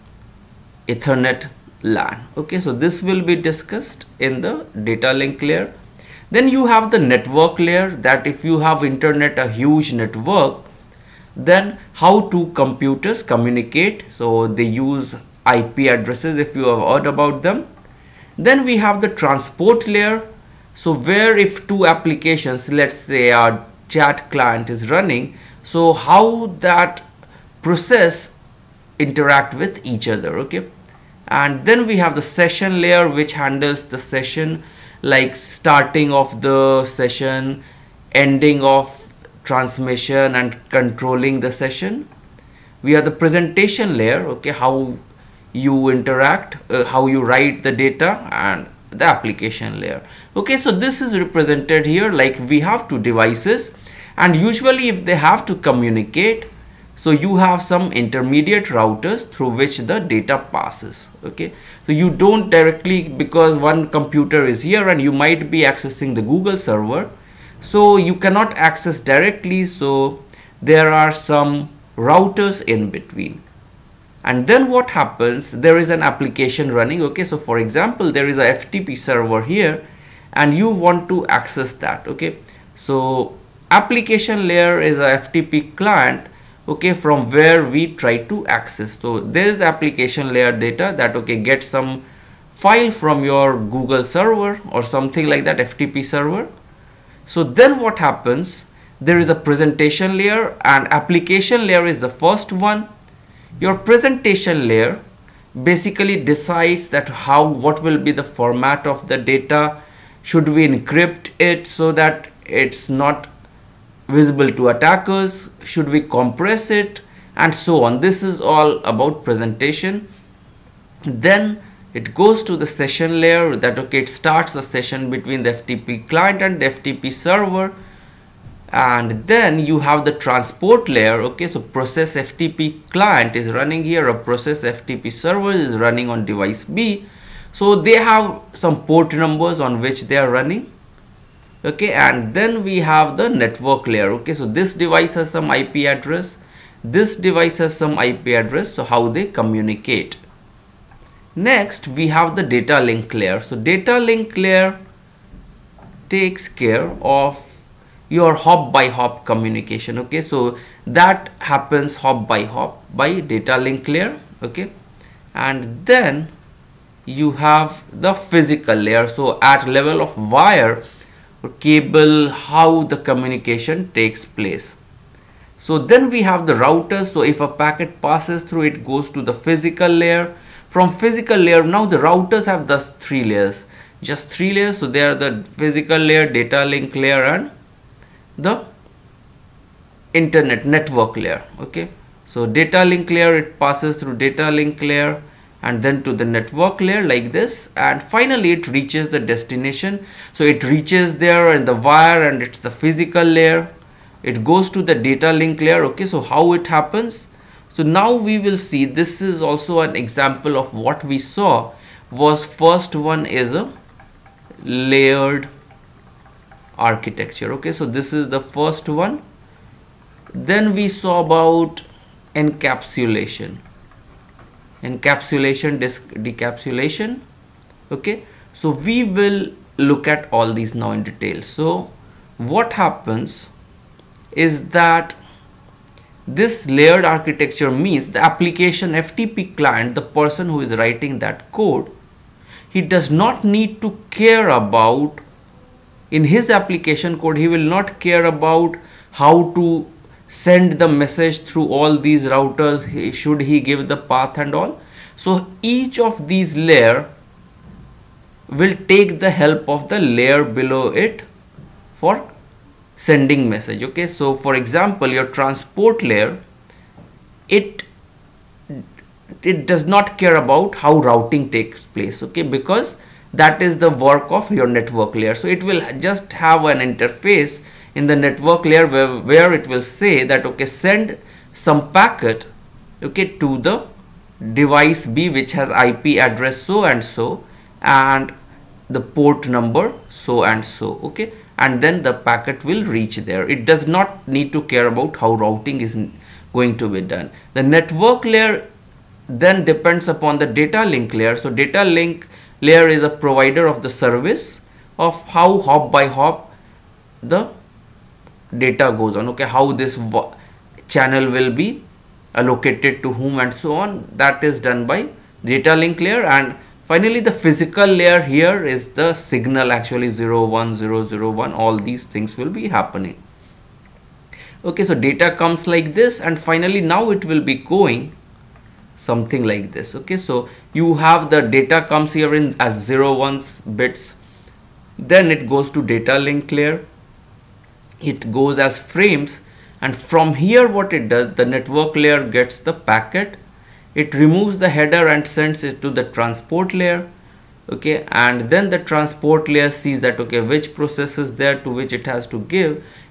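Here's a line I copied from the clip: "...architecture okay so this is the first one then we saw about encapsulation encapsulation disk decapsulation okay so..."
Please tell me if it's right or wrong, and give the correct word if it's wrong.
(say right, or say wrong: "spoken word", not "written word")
right.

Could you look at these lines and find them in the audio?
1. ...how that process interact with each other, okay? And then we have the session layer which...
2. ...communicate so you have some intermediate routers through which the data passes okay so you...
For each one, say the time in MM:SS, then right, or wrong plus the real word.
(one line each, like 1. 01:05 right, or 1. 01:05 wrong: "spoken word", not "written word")
1. 00:25 right
2. 00:55 right.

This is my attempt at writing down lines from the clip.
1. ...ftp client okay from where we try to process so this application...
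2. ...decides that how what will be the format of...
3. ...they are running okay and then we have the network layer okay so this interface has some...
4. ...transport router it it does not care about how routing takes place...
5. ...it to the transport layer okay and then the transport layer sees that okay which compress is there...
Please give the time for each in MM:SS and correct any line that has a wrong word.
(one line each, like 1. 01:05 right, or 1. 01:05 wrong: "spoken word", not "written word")
1. 01:25 wrong: "access", not "process"
2. 01:46 right
3. 02:20 wrong: "device", not "interface"
4. 04:25 wrong: "layer", not "router"
5. 05:45 wrong: "process", not "compress".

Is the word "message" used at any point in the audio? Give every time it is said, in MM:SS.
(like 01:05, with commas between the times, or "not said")
04:10, 04:23.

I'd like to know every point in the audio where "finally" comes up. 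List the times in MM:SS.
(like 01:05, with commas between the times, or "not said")
03:18, 05:16, 05:26.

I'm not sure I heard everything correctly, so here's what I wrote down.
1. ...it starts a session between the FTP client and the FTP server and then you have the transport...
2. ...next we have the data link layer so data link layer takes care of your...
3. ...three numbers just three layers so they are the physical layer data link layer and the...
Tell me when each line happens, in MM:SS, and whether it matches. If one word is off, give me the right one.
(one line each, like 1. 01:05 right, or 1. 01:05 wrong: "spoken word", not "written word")
1. 02:04 right
2. 02:31 right
3. 03:03 wrong: "layers", not "numbers".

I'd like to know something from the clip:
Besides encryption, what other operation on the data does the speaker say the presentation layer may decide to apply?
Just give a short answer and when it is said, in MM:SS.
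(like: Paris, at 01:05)
compress it, at 01:56.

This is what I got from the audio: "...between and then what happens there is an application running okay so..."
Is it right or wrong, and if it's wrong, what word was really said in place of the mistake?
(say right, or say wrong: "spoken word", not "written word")
right.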